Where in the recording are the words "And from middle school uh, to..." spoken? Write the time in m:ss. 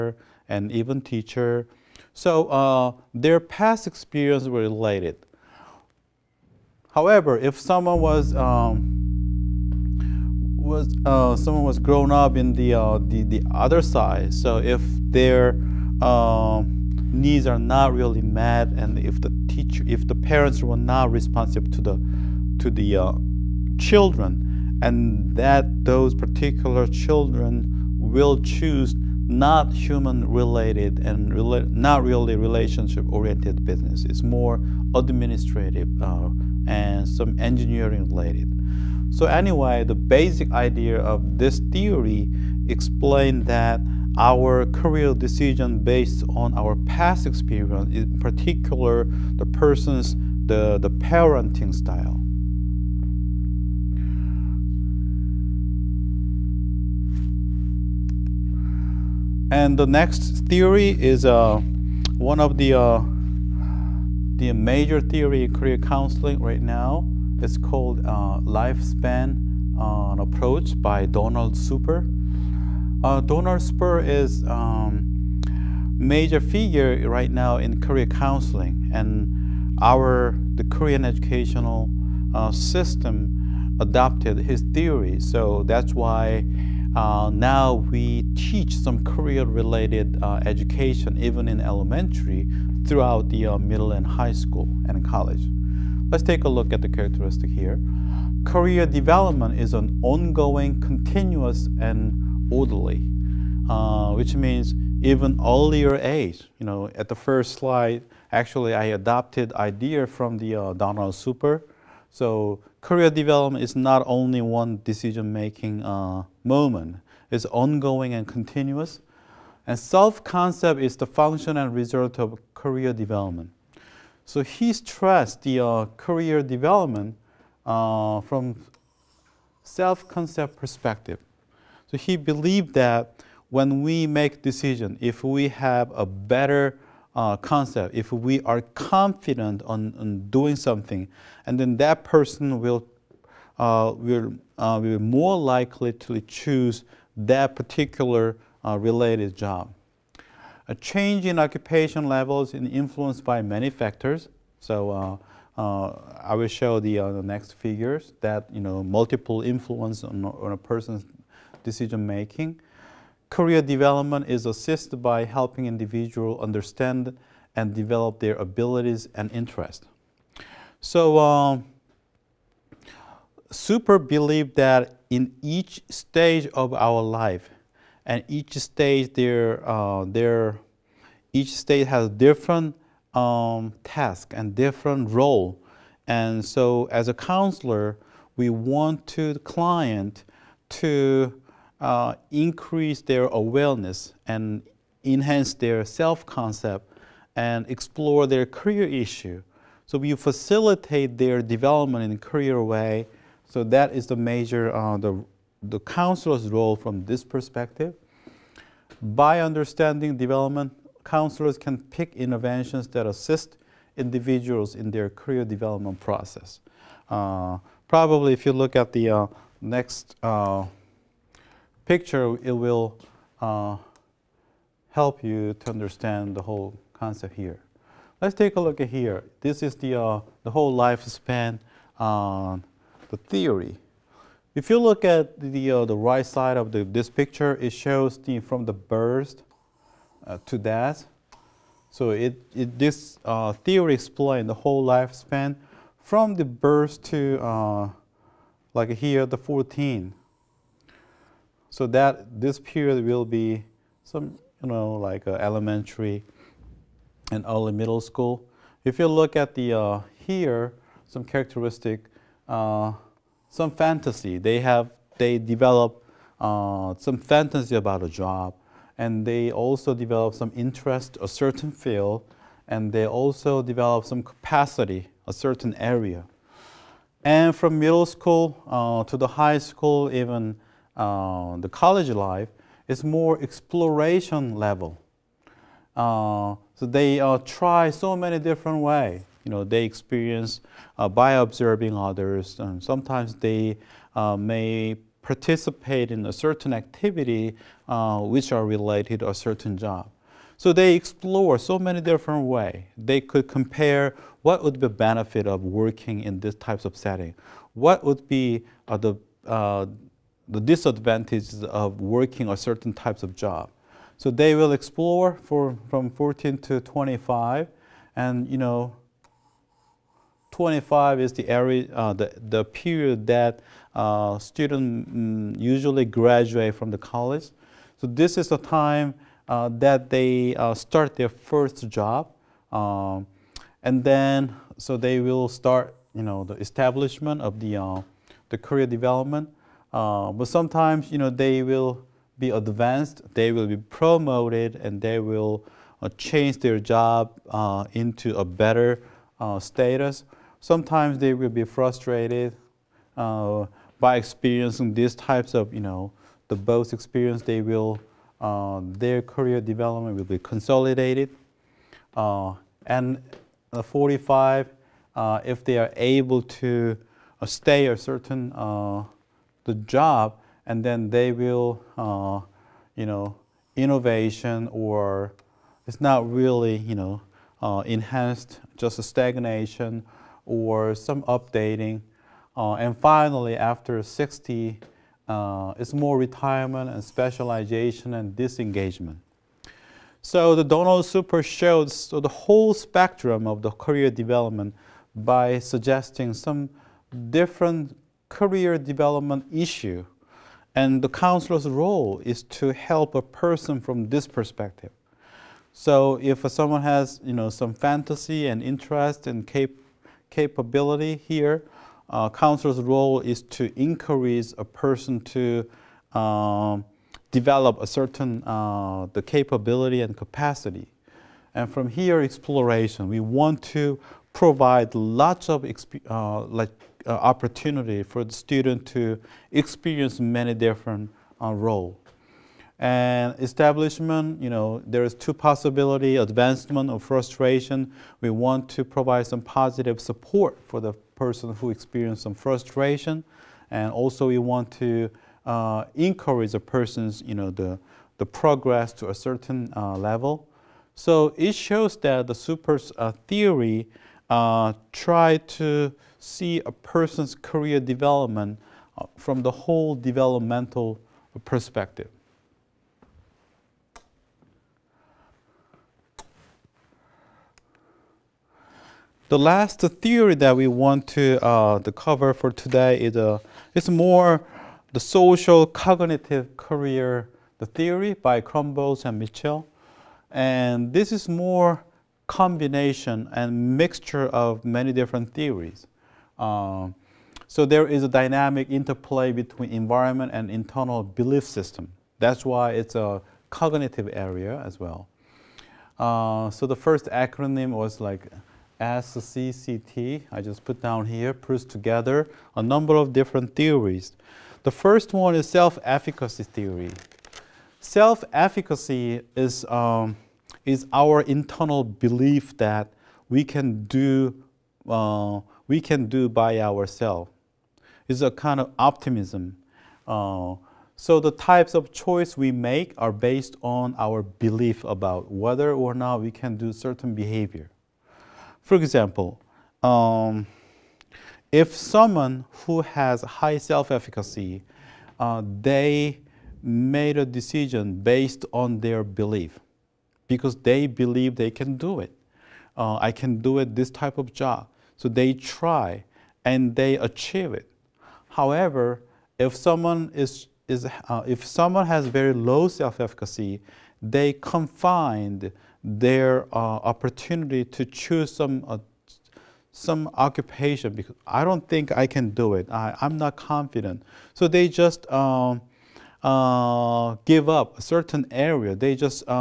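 4:37.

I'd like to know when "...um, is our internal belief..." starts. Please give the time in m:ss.
8:29.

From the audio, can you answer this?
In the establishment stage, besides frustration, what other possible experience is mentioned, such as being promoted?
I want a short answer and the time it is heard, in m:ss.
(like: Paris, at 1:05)
advancement, at 7:16.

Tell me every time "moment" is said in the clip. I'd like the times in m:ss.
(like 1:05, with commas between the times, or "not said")
1:56.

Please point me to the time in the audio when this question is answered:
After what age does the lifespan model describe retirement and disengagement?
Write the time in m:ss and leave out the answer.
6:24.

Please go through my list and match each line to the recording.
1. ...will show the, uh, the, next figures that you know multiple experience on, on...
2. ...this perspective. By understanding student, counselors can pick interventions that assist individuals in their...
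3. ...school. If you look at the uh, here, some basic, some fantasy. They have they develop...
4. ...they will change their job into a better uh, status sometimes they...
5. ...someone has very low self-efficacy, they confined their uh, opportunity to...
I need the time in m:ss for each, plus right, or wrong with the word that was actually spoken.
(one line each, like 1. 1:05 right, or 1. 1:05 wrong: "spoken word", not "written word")
1. 2:36 wrong: "influence", not "experience"
2. 3:27 wrong: "development", not "student"
3. 4:17 wrong: "characteristic", not "basic"
4. 5:45 right
5. 9:11 right.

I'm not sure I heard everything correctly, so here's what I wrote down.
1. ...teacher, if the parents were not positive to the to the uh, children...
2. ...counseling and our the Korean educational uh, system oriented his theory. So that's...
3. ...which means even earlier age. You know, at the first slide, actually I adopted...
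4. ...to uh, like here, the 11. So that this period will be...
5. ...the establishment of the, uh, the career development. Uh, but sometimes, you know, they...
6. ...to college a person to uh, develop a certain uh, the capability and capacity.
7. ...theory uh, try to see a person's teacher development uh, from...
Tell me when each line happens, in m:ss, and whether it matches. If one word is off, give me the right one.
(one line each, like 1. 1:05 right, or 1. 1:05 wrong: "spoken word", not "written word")
1. 0:19 wrong: "responsive", not "positive"
2. 1:18 wrong: "adopted", not "oriented"
3. 1:44 right
4. 4:07 wrong: "14", not "11"
5. 5:36 right
6. 6:53 wrong: "encourage", not "college"
7. 7:33 wrong: "career", not "teacher".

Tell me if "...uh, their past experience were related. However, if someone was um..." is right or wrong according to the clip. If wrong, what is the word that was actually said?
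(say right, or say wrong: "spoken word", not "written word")
right.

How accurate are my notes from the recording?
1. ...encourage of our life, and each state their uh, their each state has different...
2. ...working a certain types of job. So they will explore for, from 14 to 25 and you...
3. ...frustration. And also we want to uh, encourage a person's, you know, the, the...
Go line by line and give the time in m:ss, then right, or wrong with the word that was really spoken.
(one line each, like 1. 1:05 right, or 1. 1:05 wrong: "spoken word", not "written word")
1. 2:55 wrong: "stage", not "encourage"
2. 5:12 right
3. 7:22 right.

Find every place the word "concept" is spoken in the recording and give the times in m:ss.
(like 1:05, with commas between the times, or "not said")
1:59, 2:09, 2:17, 3:15, 3:46.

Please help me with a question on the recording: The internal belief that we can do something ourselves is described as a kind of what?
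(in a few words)
optimism.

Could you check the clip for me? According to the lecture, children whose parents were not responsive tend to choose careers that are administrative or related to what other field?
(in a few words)
engineering.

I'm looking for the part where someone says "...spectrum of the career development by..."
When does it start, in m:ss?
6:32.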